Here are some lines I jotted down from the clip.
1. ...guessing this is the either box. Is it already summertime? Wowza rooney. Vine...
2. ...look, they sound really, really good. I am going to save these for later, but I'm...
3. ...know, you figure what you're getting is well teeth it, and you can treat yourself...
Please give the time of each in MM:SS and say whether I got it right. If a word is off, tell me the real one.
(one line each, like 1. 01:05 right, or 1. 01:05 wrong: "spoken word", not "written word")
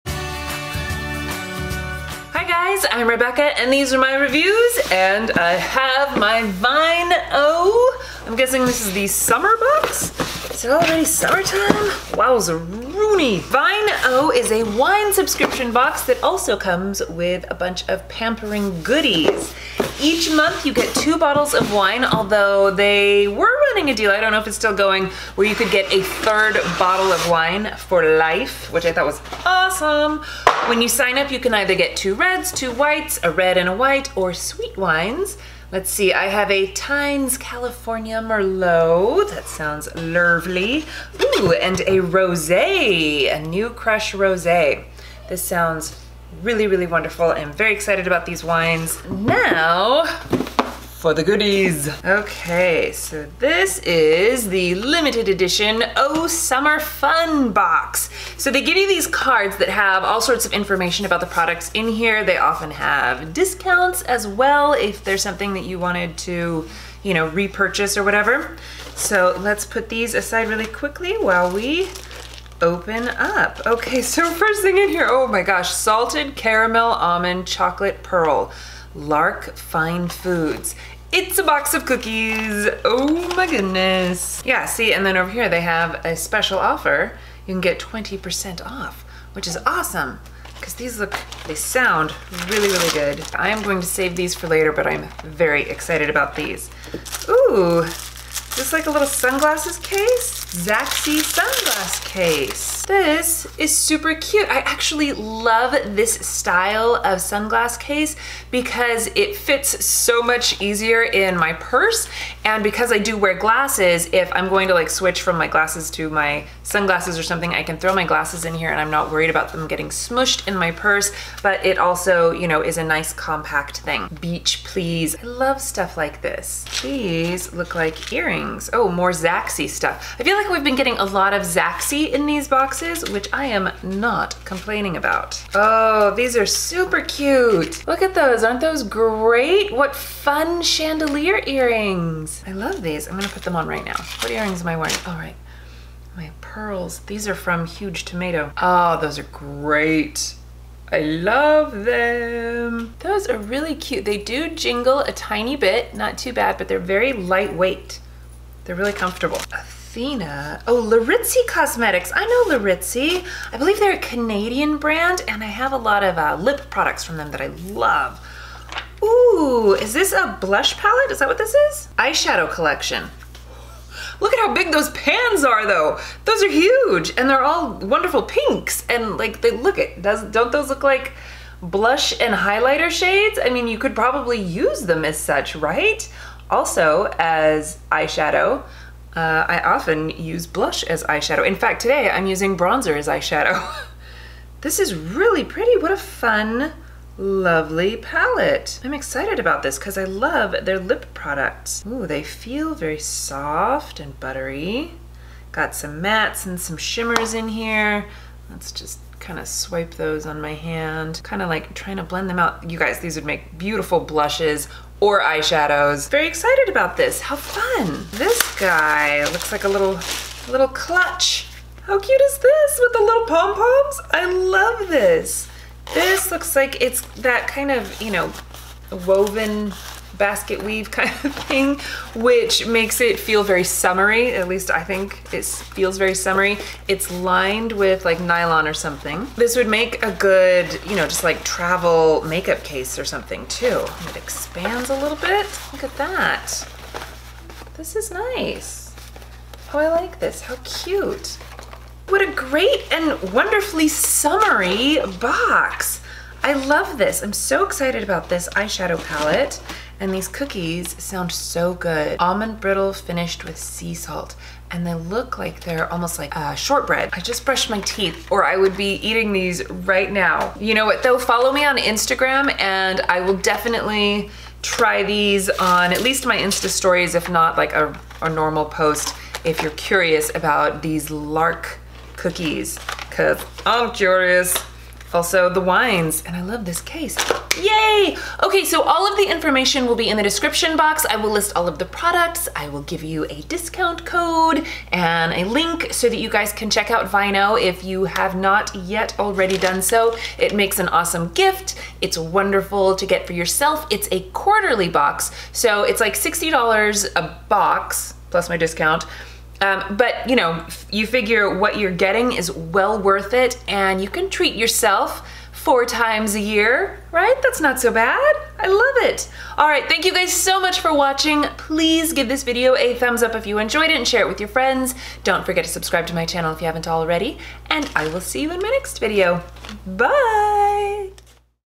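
1. 00:08 wrong: "summer", not "either"
2. 01:30 right
3. 05:10 wrong: "worth", not "teeth".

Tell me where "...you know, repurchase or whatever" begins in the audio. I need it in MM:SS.
01:07.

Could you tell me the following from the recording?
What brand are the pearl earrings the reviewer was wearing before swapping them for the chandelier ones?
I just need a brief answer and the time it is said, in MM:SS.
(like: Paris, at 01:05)
Huge Tomato, at 02:27.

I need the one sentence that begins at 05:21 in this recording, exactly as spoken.
Please give this video a thumbs up if you enjoyed it and share it with your friends.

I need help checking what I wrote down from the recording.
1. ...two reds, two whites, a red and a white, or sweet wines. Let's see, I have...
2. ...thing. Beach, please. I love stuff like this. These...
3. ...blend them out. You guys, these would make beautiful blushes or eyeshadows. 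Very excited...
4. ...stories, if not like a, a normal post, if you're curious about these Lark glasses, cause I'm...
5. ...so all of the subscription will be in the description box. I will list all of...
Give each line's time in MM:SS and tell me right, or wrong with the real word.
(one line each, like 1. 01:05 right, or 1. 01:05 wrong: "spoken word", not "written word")
1. 00:31 right
2. 02:03 right
3. 03:32 right
4. 04:36 wrong: "cookies", not "glasses"
5. 04:48 wrong: "information", not "subscription".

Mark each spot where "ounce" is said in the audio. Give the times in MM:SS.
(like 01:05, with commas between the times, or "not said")
not said.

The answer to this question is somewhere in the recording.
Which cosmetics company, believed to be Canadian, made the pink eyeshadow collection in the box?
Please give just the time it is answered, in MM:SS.
02:40.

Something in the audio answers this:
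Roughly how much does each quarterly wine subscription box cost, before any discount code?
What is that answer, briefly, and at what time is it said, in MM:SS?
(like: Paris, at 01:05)
$60, at 05:06.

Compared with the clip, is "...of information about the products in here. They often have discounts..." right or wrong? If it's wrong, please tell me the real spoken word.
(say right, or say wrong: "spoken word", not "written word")
right.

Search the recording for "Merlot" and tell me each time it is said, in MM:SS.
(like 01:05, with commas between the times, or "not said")
00:38.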